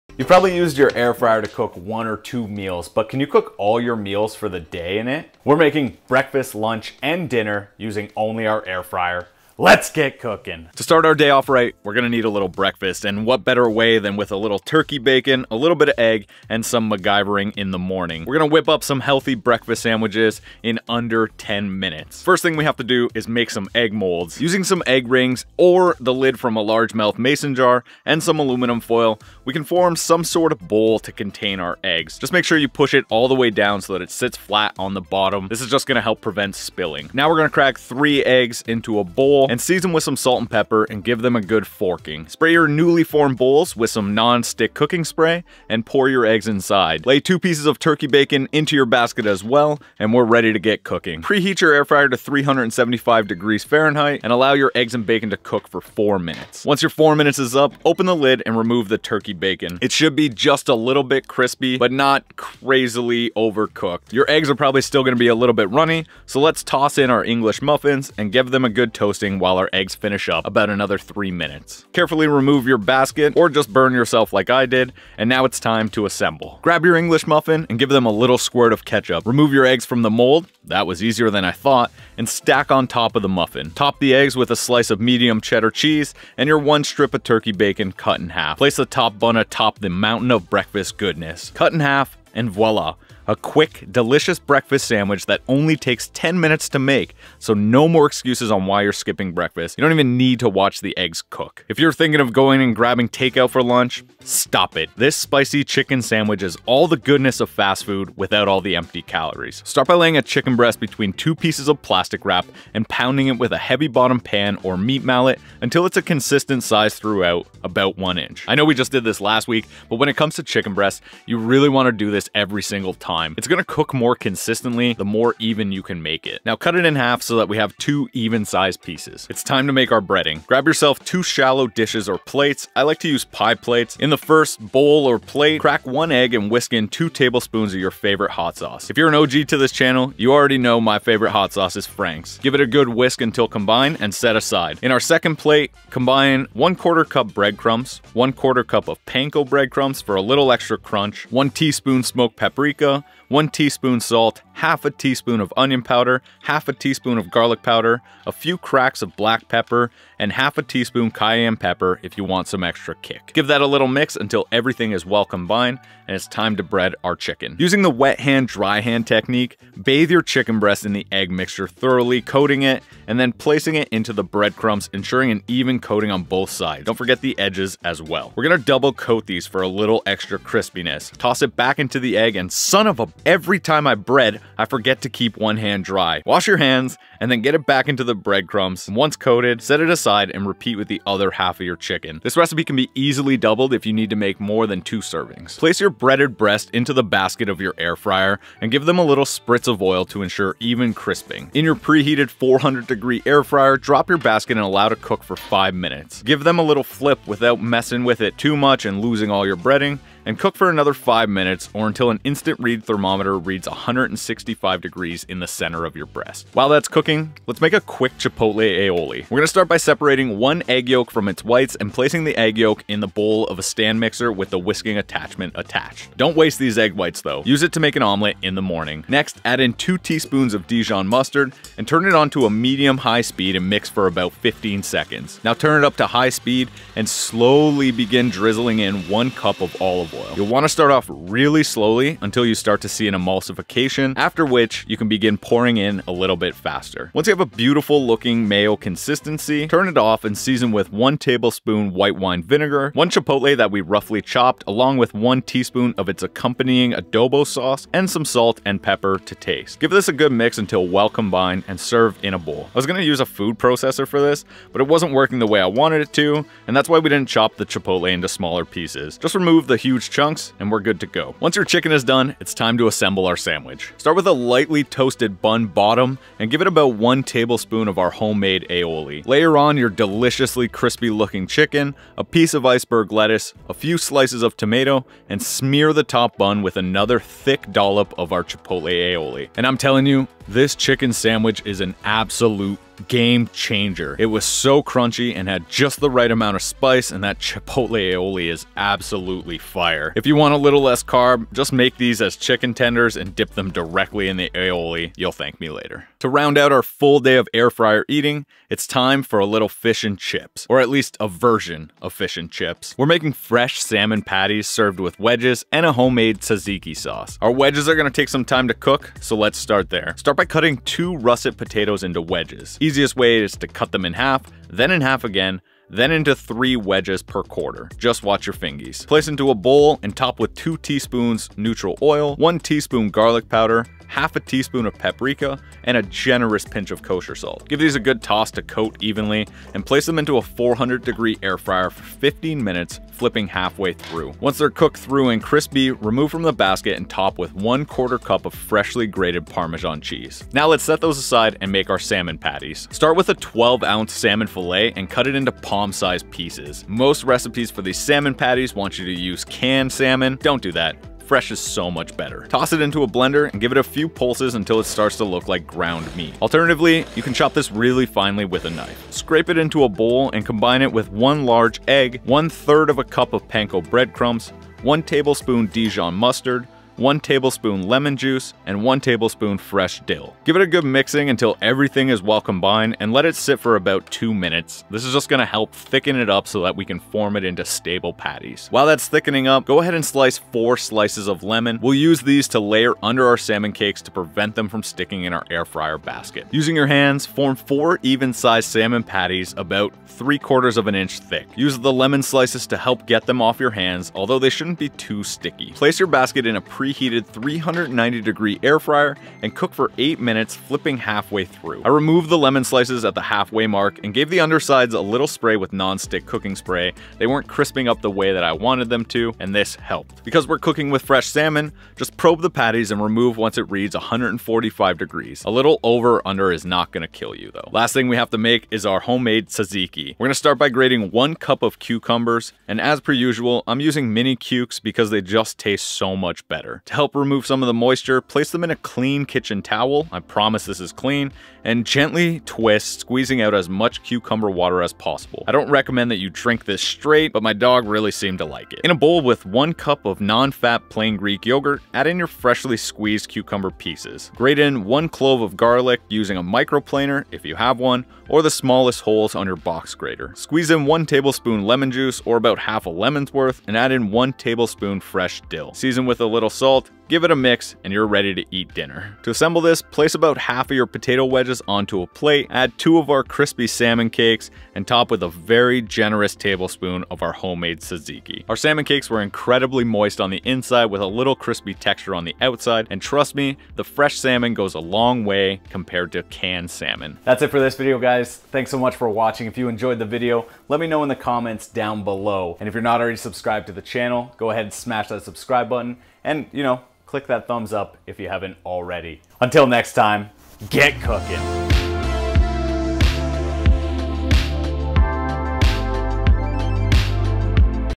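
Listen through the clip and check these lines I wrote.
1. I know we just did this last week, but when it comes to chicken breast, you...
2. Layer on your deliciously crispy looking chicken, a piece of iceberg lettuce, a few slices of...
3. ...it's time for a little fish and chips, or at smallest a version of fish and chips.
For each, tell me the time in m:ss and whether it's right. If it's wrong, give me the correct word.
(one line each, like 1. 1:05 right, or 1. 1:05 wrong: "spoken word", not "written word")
1. 1:58 right
2. 4:39 right
3. 5:08 wrong: "least", not "smallest".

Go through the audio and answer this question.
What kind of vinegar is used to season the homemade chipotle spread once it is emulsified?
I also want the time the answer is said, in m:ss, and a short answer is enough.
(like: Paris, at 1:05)
white wine vinegar, at 4:11.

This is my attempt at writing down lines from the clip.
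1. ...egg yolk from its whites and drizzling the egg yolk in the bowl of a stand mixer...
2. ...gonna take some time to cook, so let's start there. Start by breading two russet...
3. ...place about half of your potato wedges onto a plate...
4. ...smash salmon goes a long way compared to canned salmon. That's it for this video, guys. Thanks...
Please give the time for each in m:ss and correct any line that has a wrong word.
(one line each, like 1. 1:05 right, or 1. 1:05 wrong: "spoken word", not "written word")
1. 3:40 wrong: "placing", not "drizzling"
2. 5:17 wrong: "cutting", not "breading"
3. 7:49 right
4. 8:03 wrong: "fresh", not "smash".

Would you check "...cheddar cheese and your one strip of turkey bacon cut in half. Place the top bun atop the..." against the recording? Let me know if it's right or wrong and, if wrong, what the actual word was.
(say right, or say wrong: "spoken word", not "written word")
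right.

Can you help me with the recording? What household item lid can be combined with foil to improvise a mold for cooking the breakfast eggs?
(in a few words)
large mouth mason jar.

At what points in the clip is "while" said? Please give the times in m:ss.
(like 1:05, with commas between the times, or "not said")
1:09, 3:36, 6:28.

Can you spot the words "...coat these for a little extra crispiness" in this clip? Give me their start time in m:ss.
2:58.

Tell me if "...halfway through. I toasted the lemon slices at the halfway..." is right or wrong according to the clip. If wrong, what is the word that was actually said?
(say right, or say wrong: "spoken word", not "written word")
wrong: "removed", not "toasted".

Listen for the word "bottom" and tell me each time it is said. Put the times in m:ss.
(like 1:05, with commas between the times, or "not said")
0:35, 1:53, 4:35.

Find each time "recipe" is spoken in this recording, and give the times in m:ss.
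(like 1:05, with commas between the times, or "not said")
3:12, 5:57.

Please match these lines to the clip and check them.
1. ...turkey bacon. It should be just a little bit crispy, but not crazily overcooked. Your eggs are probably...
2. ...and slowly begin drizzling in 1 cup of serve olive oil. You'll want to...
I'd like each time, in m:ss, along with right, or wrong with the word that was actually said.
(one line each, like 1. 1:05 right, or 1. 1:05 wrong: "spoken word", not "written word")
1. 0:58 right
2. 3:56 wrong: "olive", not "serve".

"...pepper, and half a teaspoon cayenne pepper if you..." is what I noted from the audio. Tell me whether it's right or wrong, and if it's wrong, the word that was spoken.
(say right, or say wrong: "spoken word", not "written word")
right.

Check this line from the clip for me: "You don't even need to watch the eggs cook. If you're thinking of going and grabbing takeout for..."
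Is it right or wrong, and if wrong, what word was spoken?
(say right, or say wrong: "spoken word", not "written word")
right.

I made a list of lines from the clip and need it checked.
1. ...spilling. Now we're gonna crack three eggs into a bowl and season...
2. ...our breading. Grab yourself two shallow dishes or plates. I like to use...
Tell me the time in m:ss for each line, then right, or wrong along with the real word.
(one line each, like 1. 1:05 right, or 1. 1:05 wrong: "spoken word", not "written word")
1. 0:36 right
2. 2:09 right.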